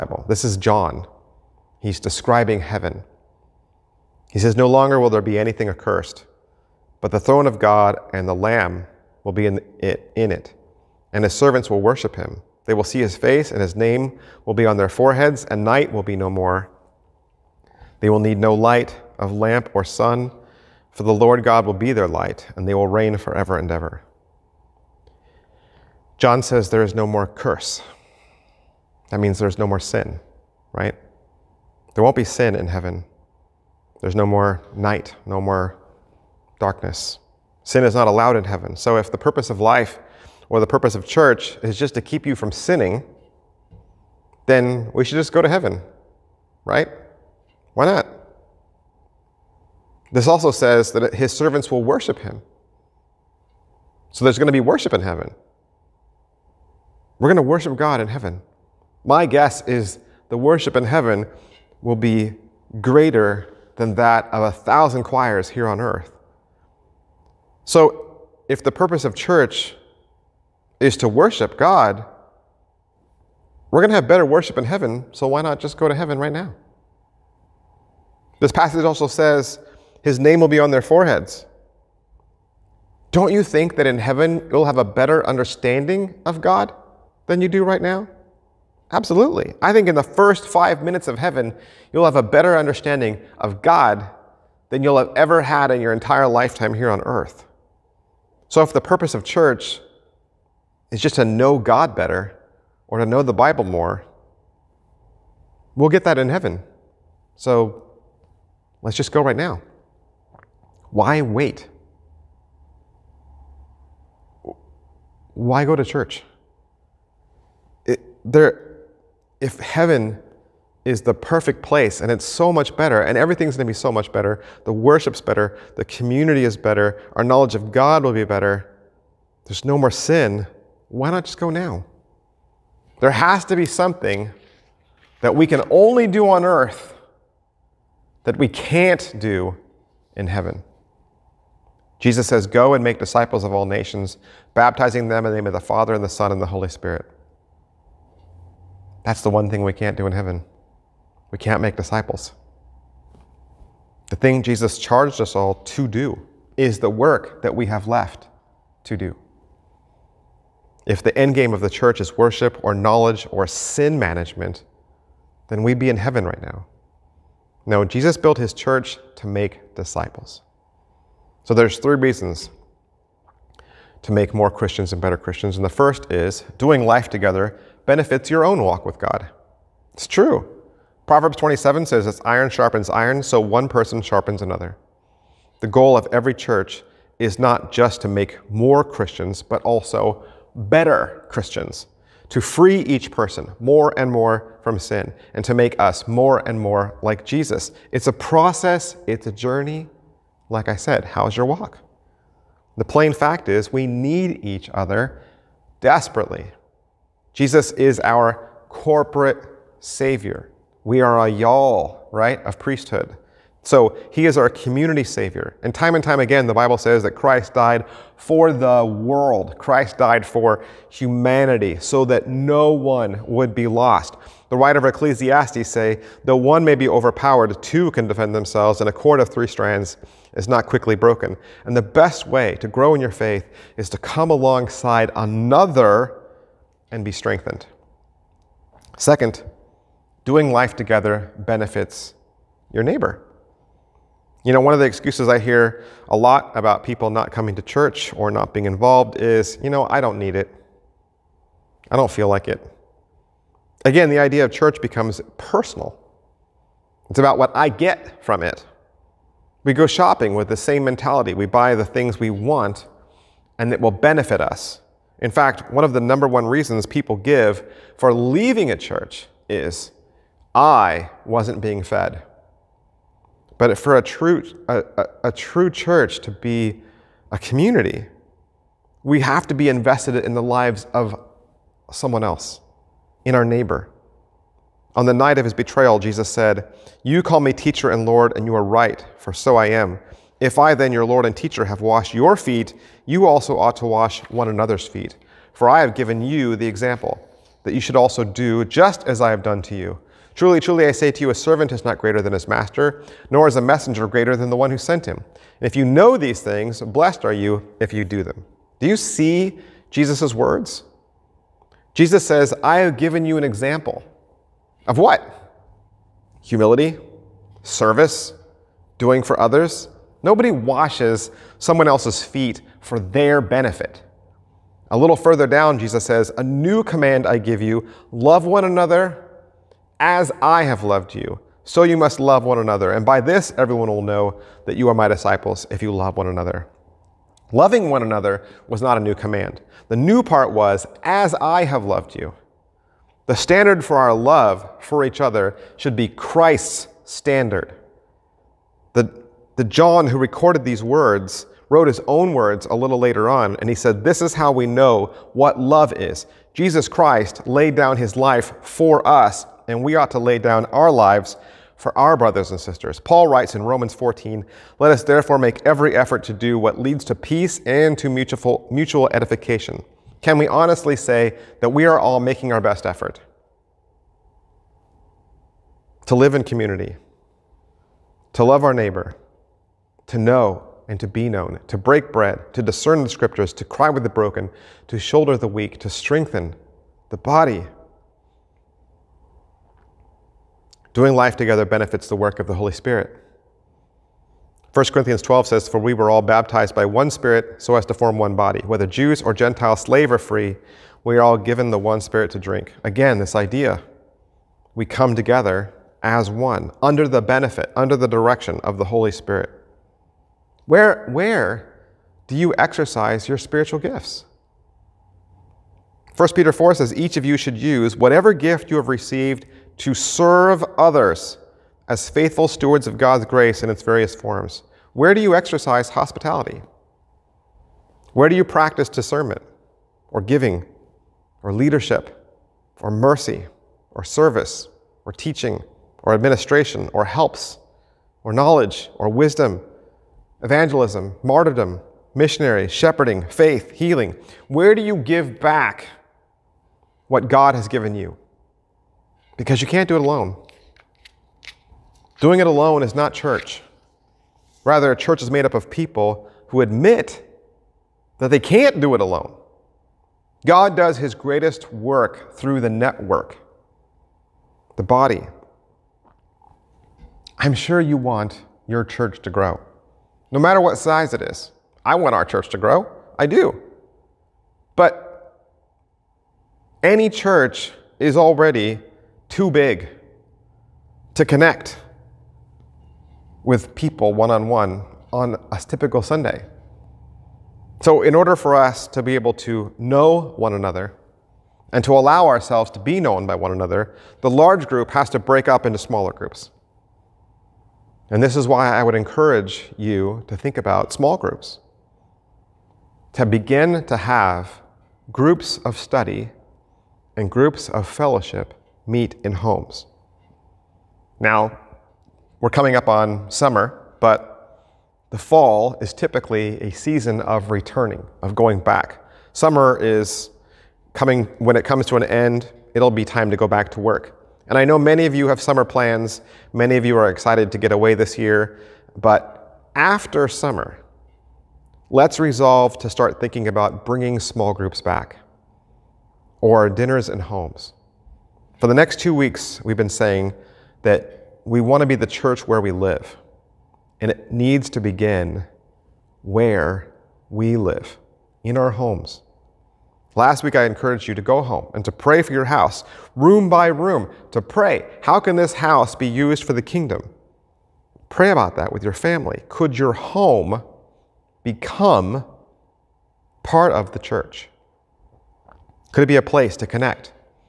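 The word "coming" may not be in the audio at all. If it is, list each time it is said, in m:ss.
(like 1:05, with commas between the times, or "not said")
4:07, 8:32, 8:40.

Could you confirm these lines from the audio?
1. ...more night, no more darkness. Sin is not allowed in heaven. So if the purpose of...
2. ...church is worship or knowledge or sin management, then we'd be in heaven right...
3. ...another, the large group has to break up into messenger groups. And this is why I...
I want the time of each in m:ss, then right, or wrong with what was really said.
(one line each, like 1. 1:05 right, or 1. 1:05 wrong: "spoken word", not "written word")
1. 0:34 right
2. 2:41 right
3. 8:13 wrong: "smaller", not "messenger".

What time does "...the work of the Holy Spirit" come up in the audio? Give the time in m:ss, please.
6:32.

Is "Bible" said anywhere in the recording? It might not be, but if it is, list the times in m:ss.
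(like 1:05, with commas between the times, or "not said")
1:43, 3:36.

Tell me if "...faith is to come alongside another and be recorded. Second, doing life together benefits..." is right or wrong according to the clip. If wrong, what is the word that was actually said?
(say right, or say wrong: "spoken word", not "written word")
wrong: "strengthened", not "recorded".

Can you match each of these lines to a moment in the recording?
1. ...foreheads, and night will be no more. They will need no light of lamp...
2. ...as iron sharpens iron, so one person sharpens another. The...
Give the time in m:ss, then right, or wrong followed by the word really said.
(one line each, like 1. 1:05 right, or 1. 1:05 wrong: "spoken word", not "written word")
1. 0:14 right
2. 3:02 right.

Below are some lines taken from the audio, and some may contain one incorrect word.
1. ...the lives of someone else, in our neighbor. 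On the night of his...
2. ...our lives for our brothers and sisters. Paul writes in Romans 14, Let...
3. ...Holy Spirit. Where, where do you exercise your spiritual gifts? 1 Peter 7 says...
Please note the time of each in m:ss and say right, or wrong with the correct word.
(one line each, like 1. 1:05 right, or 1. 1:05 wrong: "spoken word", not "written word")
1. 4:40 right
2. 6:00 right
3. 6:48 wrong: "4", not "7".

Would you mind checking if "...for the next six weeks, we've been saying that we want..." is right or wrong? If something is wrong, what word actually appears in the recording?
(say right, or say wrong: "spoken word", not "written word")
wrong: "two", not "six".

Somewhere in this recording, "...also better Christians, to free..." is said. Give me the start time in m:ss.
3:09.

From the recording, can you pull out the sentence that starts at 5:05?
And if you know these things, blessed are you if you do them.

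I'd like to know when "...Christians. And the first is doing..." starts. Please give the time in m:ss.
2:55.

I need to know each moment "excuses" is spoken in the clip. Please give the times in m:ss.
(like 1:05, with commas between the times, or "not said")
4:04.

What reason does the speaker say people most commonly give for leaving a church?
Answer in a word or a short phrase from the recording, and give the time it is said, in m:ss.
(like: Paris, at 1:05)
I wasn't being fed, at 4:30.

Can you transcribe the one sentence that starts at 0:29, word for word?
That means there's no more sin, right?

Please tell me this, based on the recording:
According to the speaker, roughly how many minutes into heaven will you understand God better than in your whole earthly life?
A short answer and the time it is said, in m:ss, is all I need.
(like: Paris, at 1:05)
5, at 1:30.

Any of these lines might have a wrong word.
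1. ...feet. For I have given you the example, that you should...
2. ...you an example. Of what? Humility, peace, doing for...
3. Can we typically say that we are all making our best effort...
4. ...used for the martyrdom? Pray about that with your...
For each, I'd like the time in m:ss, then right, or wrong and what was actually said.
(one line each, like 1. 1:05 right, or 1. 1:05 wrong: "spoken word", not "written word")
1. 4:54 right
2. 5:13 wrong: "service", not "peace"
3. 6:10 wrong: "honestly", not "typically"
4. 9:16 wrong: "kingdom", not "martyrdom".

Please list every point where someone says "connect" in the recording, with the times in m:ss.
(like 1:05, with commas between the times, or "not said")
8:01, 9:26.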